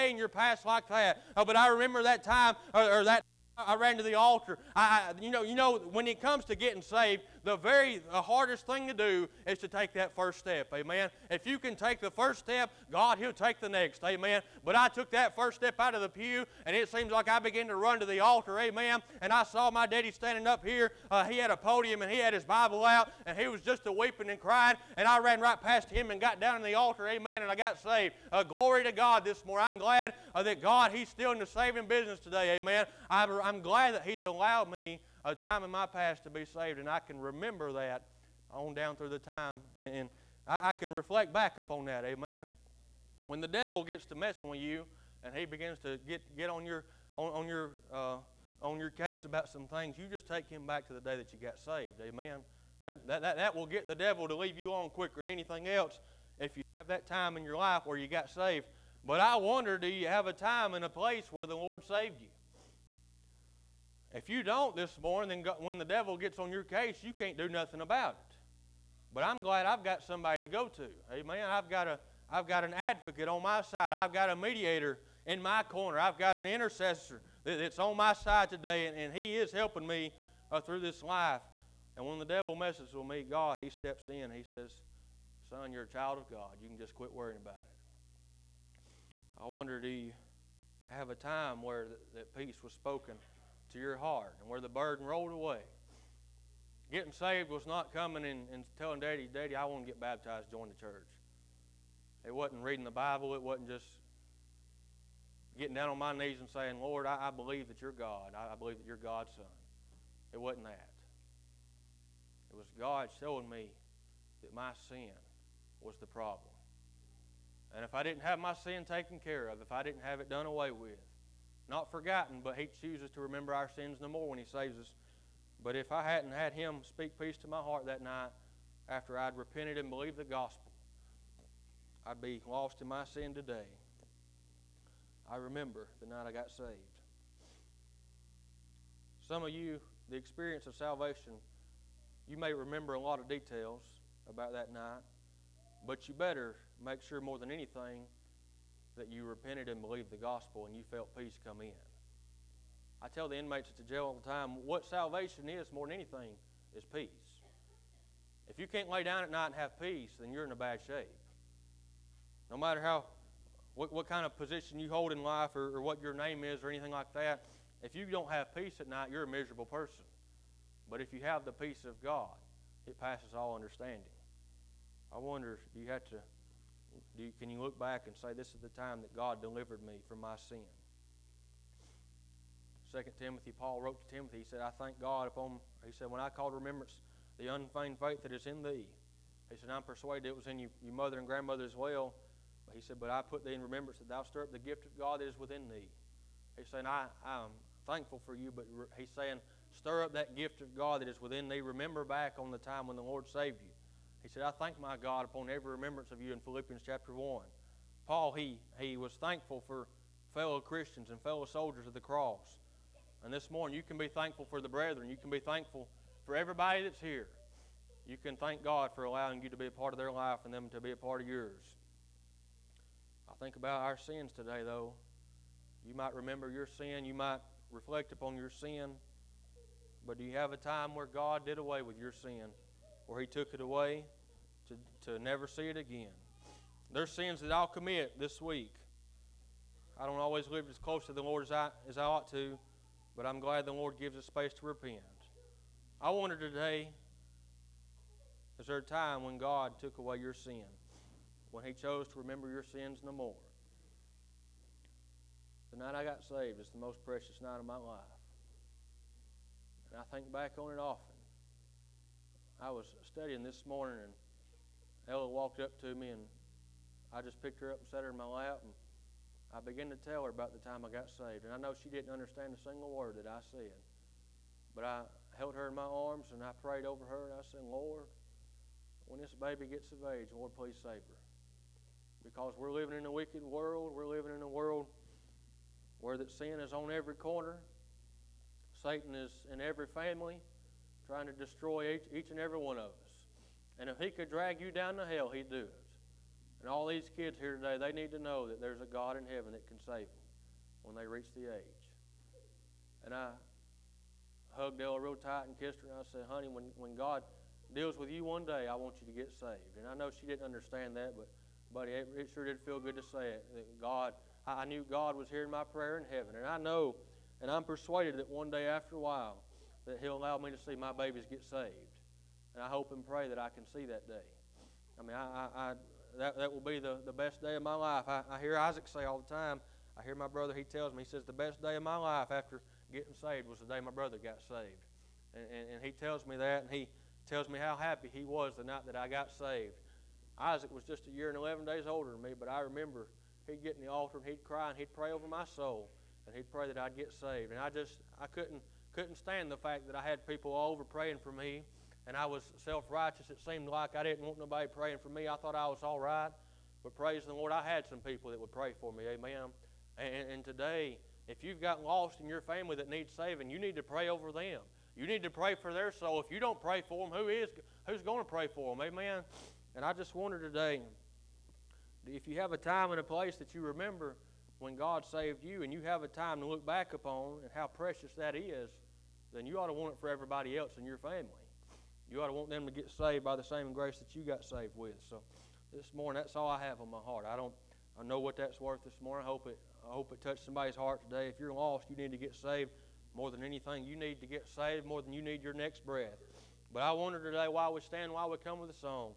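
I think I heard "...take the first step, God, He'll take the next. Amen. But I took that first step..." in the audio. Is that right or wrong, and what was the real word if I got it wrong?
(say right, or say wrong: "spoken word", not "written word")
right.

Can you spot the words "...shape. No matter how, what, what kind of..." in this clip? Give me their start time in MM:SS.
02:40.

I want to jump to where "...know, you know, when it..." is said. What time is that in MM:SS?
00:05.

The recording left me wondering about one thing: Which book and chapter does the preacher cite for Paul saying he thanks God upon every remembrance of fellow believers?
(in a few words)
Philippians chapter 1.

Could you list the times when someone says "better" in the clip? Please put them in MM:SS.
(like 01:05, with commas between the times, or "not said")
02:26.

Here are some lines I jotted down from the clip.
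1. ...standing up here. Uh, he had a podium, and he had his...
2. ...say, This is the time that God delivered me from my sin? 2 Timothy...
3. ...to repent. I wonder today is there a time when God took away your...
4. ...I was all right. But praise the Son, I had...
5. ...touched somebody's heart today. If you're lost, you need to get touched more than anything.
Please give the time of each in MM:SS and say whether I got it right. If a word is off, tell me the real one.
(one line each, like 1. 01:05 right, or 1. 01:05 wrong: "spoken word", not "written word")
1. 00:20 right
2. 02:58 right
3. 04:04 right
4. 05:55 wrong: "Lord", not "Son"
5. 06:30 wrong: "saved", not "touched".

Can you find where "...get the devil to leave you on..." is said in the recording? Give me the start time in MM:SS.
00:53.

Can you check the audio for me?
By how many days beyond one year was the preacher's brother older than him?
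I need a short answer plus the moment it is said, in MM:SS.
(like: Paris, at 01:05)
11, at 05:41.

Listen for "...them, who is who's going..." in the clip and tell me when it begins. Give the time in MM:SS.
06:07.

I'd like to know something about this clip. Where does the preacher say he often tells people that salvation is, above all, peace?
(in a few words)
The jail.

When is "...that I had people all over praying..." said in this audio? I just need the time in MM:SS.
05:49.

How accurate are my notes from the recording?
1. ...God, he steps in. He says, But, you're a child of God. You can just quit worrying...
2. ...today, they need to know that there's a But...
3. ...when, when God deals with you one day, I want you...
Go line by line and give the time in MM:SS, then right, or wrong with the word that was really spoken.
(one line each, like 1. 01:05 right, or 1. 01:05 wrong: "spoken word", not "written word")
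1. 01:23 wrong: "Son", not "But"
2. 04:57 wrong: "God", not "But"
3. 05:06 right.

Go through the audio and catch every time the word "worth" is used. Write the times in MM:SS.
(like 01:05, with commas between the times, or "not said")
06:28.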